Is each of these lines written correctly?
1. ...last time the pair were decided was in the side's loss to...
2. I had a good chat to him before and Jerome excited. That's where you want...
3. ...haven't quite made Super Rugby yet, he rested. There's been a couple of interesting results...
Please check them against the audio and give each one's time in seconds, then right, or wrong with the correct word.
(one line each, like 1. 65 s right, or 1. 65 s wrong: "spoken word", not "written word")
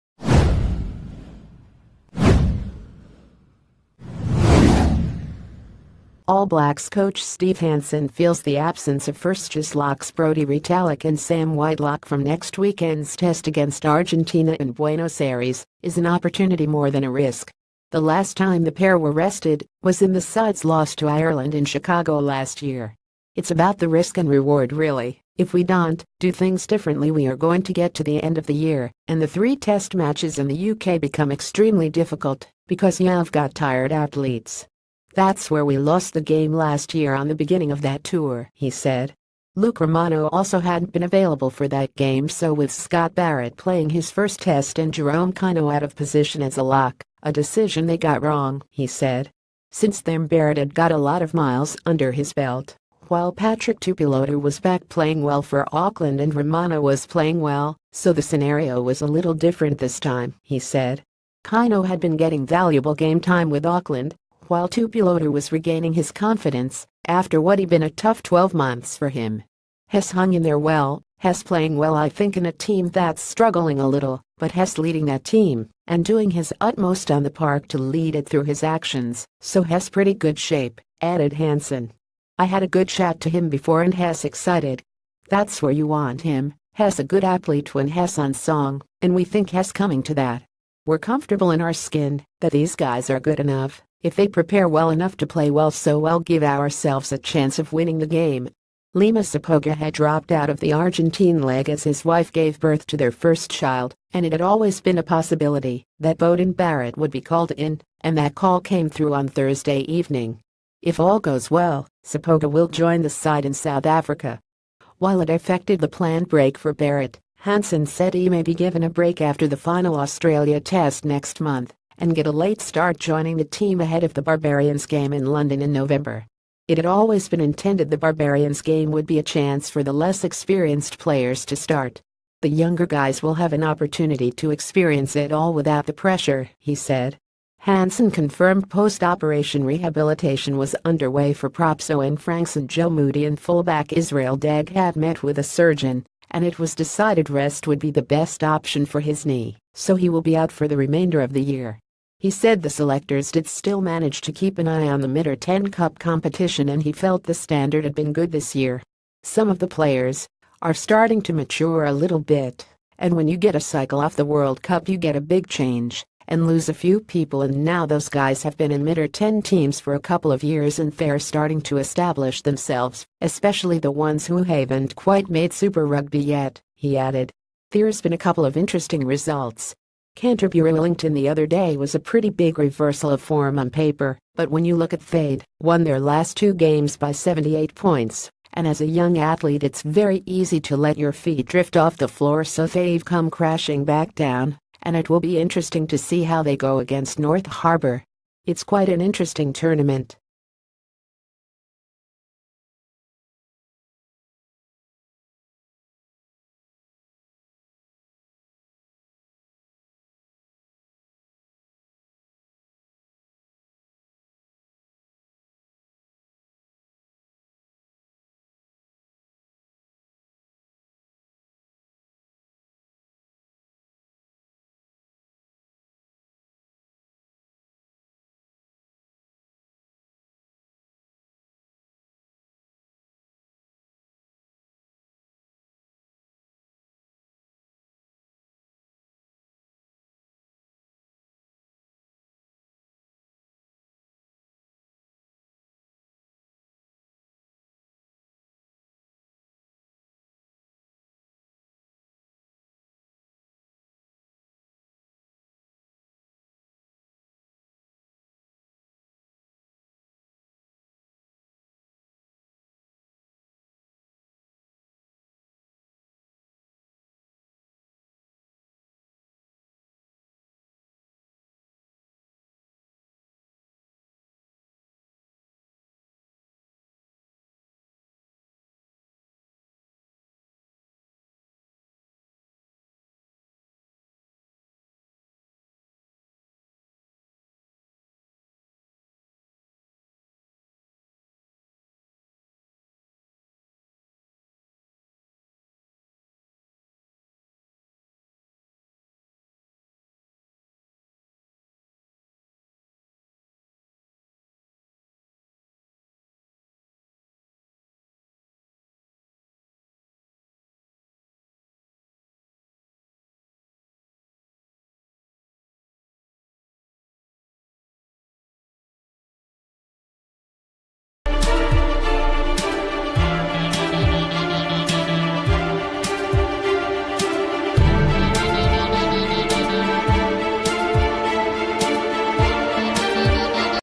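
1. 17 s wrong: "rested", not "decided"
2. 82 s wrong: "Hess", not "Jerome"
3. 174 s wrong: "added", not "rested".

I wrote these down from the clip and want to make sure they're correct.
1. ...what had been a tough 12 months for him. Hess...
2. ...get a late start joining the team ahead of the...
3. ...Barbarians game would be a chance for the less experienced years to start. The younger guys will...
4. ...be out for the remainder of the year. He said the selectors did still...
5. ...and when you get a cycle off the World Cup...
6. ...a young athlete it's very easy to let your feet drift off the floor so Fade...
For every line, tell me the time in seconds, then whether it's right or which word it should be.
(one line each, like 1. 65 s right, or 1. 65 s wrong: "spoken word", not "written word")
1. 67 s right
2. 122 s right
3. 127 s wrong: "players", not "years"
4. 150 s right
5. 162 s right
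6. 188 s right.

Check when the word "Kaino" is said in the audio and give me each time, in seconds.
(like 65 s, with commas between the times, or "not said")
45 s, 61 s.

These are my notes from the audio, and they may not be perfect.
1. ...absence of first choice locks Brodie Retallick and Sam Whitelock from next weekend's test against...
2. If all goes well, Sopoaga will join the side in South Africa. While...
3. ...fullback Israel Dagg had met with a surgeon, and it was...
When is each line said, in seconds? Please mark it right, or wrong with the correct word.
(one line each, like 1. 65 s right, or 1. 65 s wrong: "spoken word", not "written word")
1. 8 s right
2. 110 s right
3. 143 s right.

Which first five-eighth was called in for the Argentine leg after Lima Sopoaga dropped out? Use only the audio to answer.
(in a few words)
Beauden Barrett.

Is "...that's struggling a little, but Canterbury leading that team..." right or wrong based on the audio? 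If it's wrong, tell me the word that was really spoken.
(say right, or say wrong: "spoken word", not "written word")
wrong: "Hess", not "Canterbury".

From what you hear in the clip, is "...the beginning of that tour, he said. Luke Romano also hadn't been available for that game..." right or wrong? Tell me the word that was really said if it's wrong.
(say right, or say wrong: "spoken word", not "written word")
right.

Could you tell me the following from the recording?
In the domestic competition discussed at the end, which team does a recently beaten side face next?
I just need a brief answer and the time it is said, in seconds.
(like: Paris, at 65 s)
North Harbour, at 197 s.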